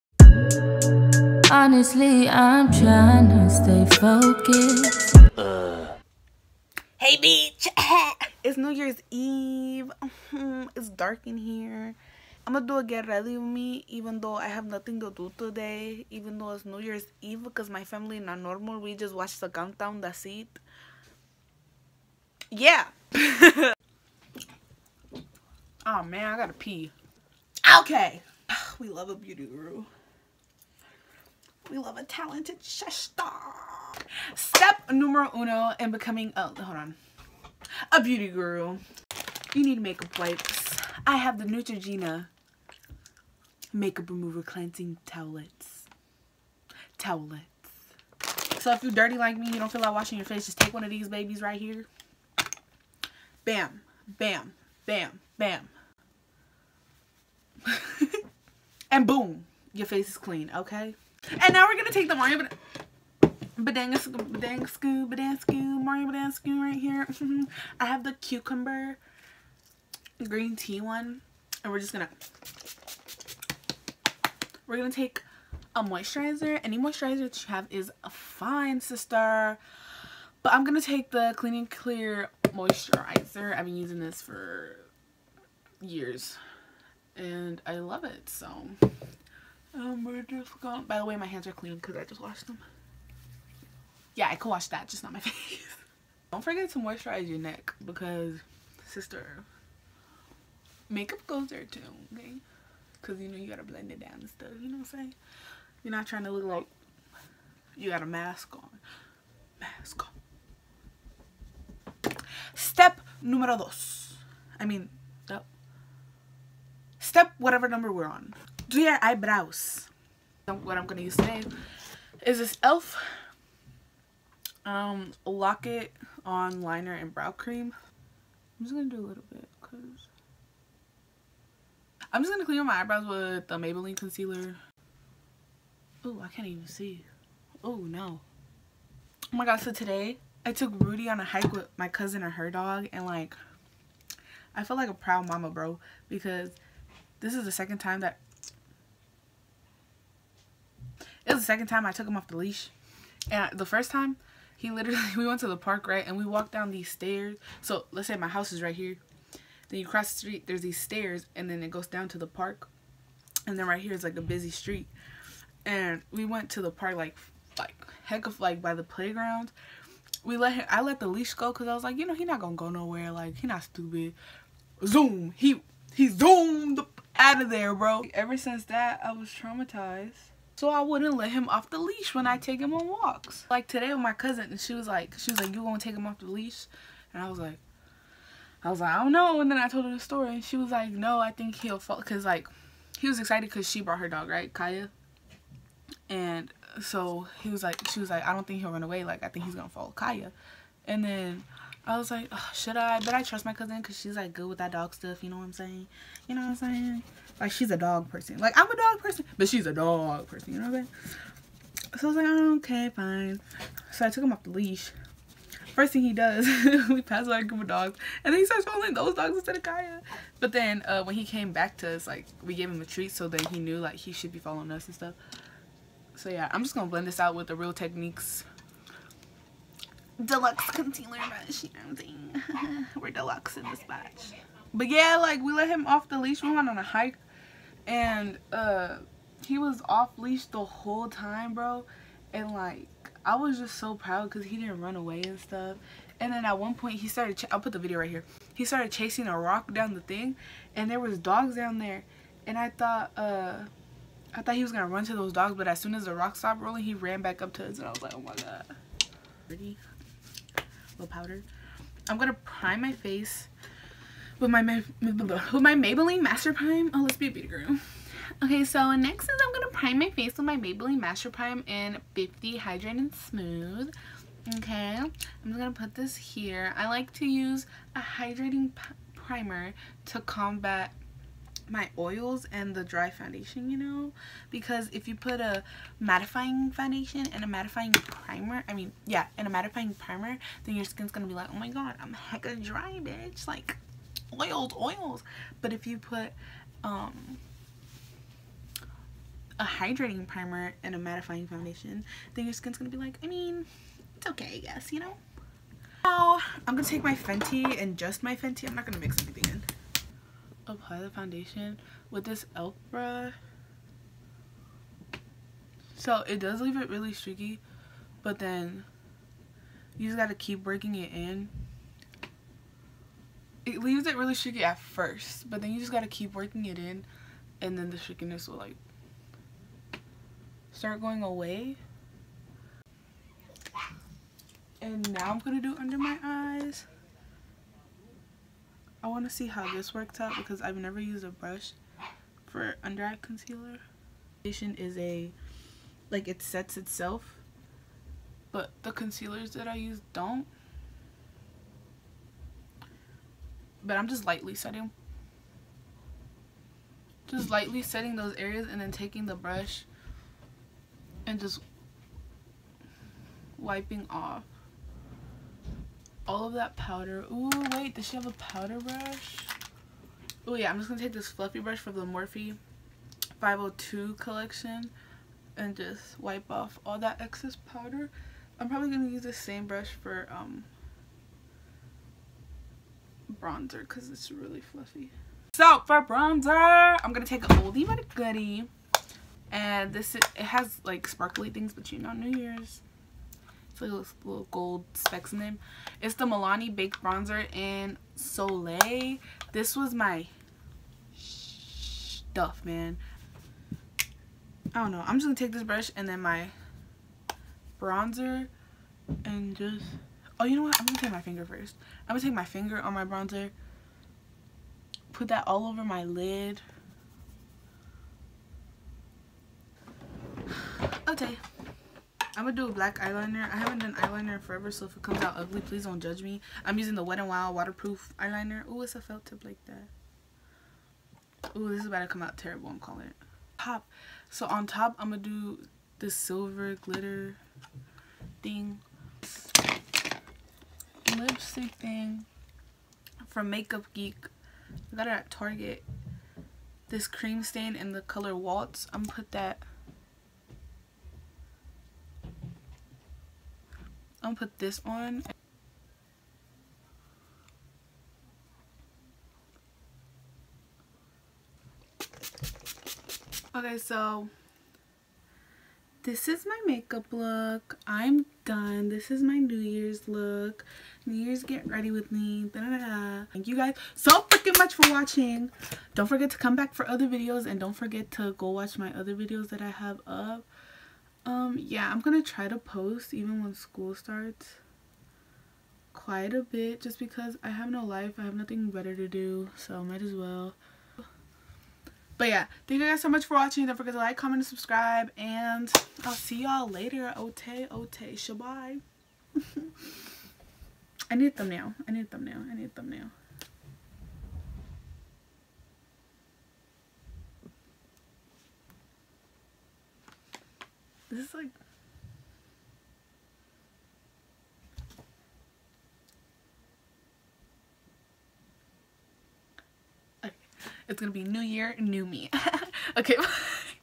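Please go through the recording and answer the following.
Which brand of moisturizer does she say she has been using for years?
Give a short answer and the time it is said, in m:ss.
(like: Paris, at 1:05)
Clean and Clear, at 1:21.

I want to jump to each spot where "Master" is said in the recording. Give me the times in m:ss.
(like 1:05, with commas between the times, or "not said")
4:26, 4:30.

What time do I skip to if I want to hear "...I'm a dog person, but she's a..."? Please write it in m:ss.
3:28.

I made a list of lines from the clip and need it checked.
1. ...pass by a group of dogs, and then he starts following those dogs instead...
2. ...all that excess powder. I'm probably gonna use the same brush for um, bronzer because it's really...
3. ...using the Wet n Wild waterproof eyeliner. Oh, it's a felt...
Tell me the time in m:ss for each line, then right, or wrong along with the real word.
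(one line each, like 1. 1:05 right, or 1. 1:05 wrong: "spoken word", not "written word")
1. 3:37 right
2. 6:16 right
3. 7:06 right.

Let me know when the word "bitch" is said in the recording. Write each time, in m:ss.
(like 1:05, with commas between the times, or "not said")
0:07, 4:53.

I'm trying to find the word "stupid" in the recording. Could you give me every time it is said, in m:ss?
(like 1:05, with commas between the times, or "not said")
2:53.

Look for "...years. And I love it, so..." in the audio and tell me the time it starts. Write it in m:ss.
1:25.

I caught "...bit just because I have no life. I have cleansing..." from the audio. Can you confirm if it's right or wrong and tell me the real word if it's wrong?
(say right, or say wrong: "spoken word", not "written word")
wrong: "nothing", not "cleansing".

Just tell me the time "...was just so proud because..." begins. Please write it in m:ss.
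4:03.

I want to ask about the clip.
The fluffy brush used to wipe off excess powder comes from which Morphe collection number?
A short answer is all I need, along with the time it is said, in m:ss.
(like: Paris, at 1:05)
502, at 6:13.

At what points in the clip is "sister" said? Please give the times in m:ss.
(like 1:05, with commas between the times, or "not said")
1:18, 1:38.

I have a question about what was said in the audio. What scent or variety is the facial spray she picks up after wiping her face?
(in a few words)
cucumber green tea.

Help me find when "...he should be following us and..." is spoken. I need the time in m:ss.
3:43.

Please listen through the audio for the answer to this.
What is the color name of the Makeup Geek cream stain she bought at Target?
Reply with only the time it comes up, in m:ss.
7:28.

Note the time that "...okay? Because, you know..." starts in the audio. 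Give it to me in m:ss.
1:42.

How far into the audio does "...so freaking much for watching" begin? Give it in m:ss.
7:53.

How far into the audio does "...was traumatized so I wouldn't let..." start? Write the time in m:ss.
2:59.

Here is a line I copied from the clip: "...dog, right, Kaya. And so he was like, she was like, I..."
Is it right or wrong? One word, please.
right.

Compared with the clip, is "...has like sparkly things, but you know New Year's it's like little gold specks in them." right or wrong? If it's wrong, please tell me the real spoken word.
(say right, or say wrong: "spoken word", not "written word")
right.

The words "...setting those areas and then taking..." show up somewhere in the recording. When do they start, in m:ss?
5:57.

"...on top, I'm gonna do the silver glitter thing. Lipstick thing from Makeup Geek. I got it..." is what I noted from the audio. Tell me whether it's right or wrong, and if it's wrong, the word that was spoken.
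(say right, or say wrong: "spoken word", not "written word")
right.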